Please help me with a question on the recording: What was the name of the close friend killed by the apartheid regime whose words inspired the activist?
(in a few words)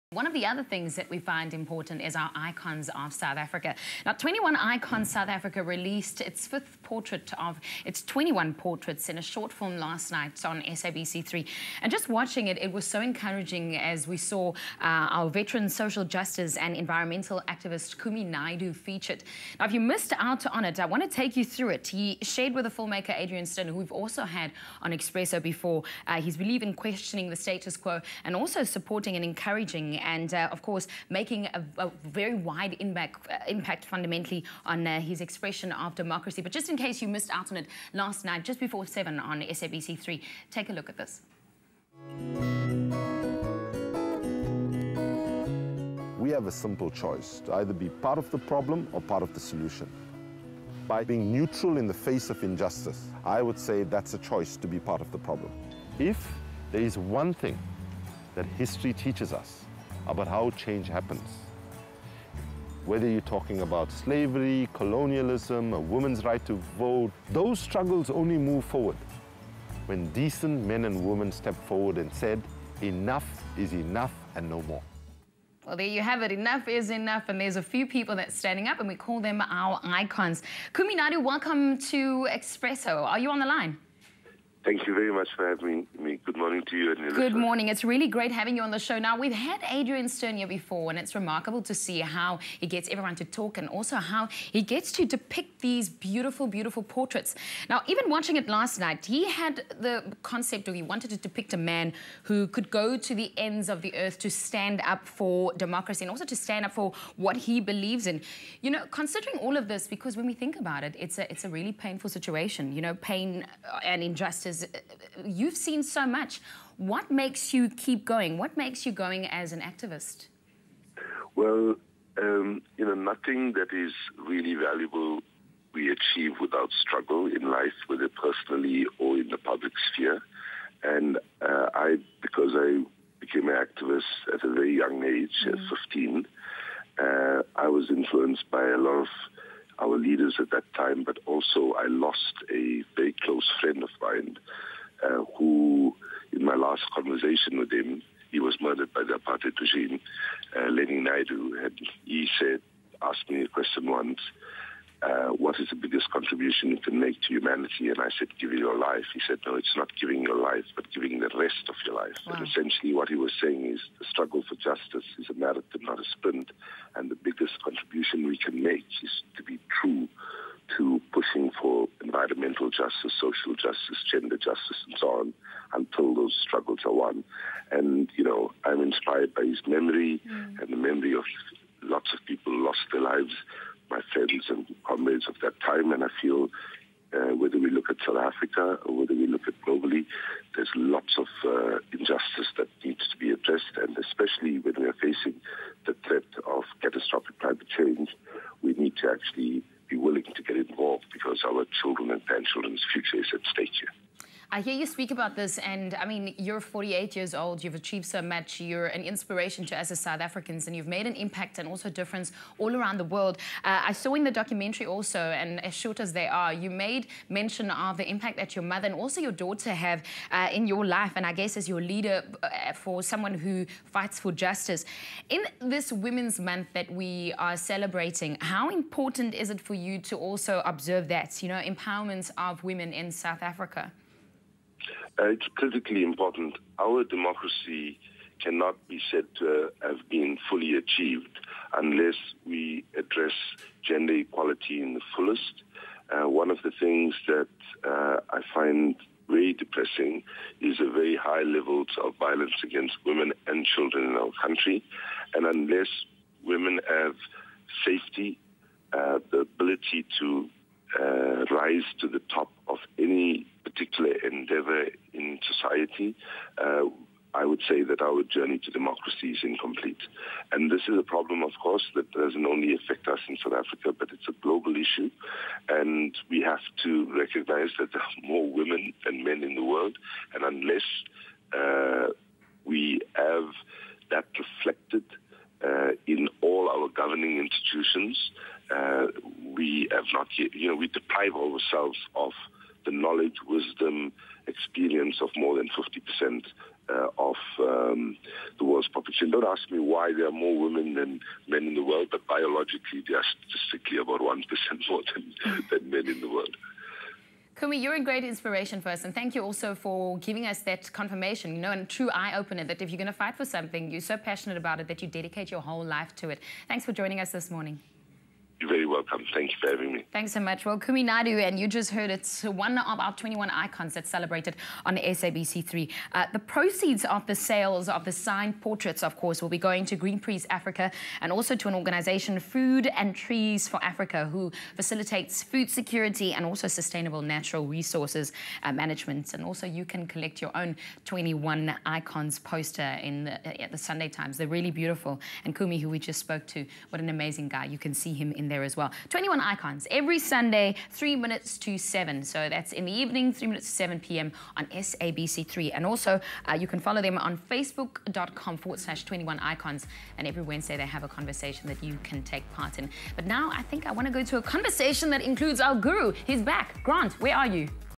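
Lenny Naidoo.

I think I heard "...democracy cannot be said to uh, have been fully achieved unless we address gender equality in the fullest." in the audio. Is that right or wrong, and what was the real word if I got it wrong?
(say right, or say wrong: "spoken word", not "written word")
right.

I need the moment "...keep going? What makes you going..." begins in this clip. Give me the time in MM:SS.
01:57.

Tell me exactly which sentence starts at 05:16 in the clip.
Thanks for joining us this morning.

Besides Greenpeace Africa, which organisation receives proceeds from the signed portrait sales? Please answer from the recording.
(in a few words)
Food and Trees for Africa.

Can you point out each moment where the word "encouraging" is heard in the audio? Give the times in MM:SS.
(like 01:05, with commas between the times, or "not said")
00:12, 00:29.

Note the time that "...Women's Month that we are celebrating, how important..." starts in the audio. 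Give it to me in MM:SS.
03:45.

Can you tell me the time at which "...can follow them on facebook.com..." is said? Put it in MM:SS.
05:56.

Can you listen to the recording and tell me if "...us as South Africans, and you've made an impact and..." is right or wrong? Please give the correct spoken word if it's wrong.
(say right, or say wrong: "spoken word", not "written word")
right.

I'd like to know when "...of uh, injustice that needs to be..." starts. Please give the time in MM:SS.
03:11.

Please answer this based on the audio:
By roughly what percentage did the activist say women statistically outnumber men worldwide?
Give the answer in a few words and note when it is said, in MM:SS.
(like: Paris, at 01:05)
1%, at 05:04.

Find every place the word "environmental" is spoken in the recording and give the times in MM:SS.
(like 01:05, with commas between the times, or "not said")
00:16, 02:52.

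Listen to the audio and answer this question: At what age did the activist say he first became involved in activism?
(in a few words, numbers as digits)
15.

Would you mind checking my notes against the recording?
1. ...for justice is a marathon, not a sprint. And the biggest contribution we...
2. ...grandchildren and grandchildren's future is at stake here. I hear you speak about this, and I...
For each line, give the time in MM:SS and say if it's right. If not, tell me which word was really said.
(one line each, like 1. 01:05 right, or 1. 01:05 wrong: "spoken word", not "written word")
1. 02:44 right
2. 03:21 wrong: "children", not "grandchildren".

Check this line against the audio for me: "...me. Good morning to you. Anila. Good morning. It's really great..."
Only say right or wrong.
right.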